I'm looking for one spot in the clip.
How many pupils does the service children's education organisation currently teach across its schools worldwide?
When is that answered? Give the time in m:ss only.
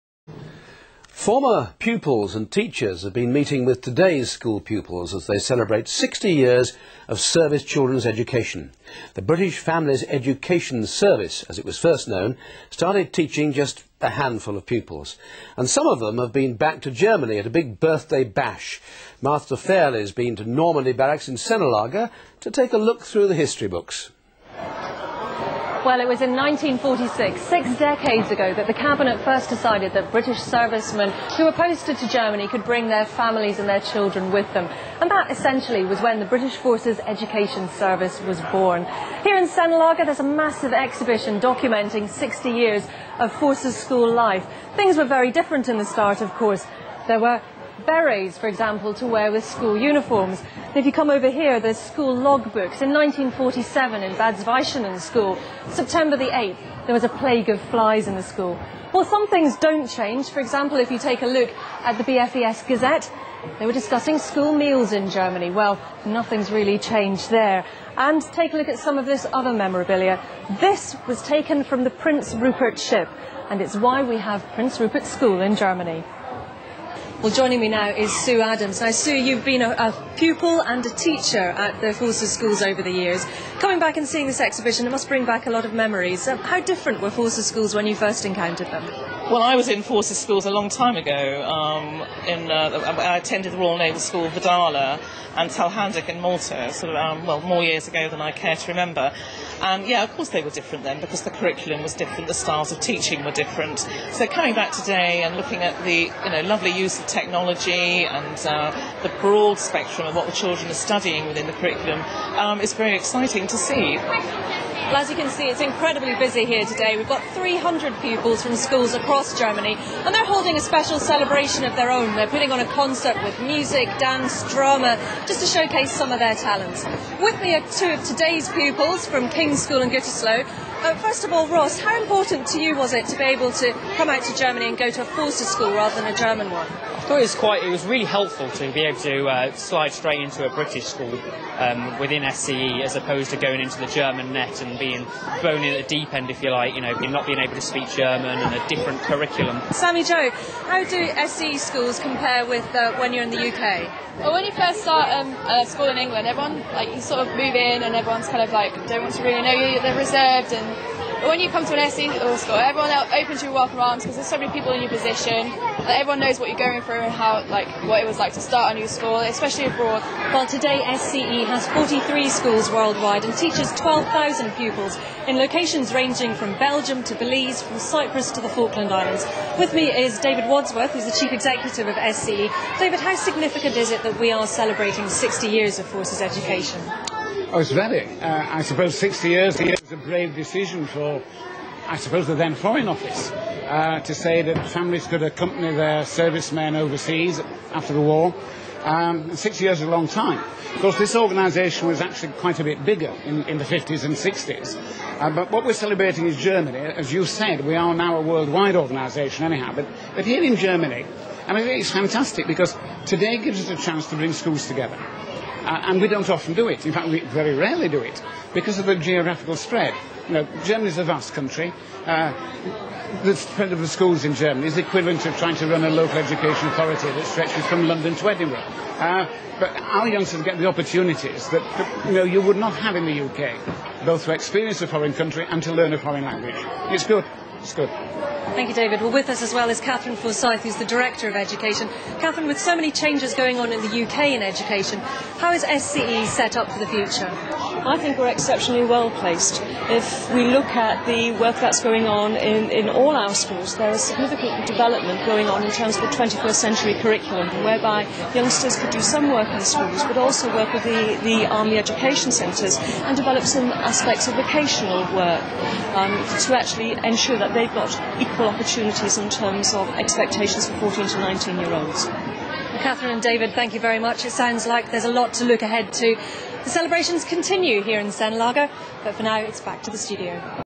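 2:53.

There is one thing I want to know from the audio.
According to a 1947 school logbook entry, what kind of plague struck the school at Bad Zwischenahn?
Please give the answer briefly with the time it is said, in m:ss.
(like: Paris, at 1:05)
Flies, at 0:57.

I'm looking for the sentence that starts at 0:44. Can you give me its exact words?
Things were very different in the start, of course.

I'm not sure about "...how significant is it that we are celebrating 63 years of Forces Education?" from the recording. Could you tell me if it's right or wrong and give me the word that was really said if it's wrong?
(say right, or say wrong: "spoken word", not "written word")
wrong: "60", not "63".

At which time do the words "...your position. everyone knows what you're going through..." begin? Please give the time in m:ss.
2:44.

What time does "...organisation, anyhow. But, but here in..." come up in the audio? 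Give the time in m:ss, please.
3:28.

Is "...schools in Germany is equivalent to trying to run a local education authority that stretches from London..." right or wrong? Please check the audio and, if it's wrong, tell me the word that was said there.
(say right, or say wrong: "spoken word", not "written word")
right.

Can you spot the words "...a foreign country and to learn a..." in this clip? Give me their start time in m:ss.
3:54.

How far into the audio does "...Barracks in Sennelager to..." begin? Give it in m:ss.
0:20.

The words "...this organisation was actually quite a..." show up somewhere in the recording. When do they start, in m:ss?
3:20.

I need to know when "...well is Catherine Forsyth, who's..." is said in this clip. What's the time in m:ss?
3:59.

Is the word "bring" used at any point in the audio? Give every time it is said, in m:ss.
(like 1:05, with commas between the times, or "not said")
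0:32, 1:25, 3:34.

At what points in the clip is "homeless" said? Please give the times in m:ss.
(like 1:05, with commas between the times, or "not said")
not said.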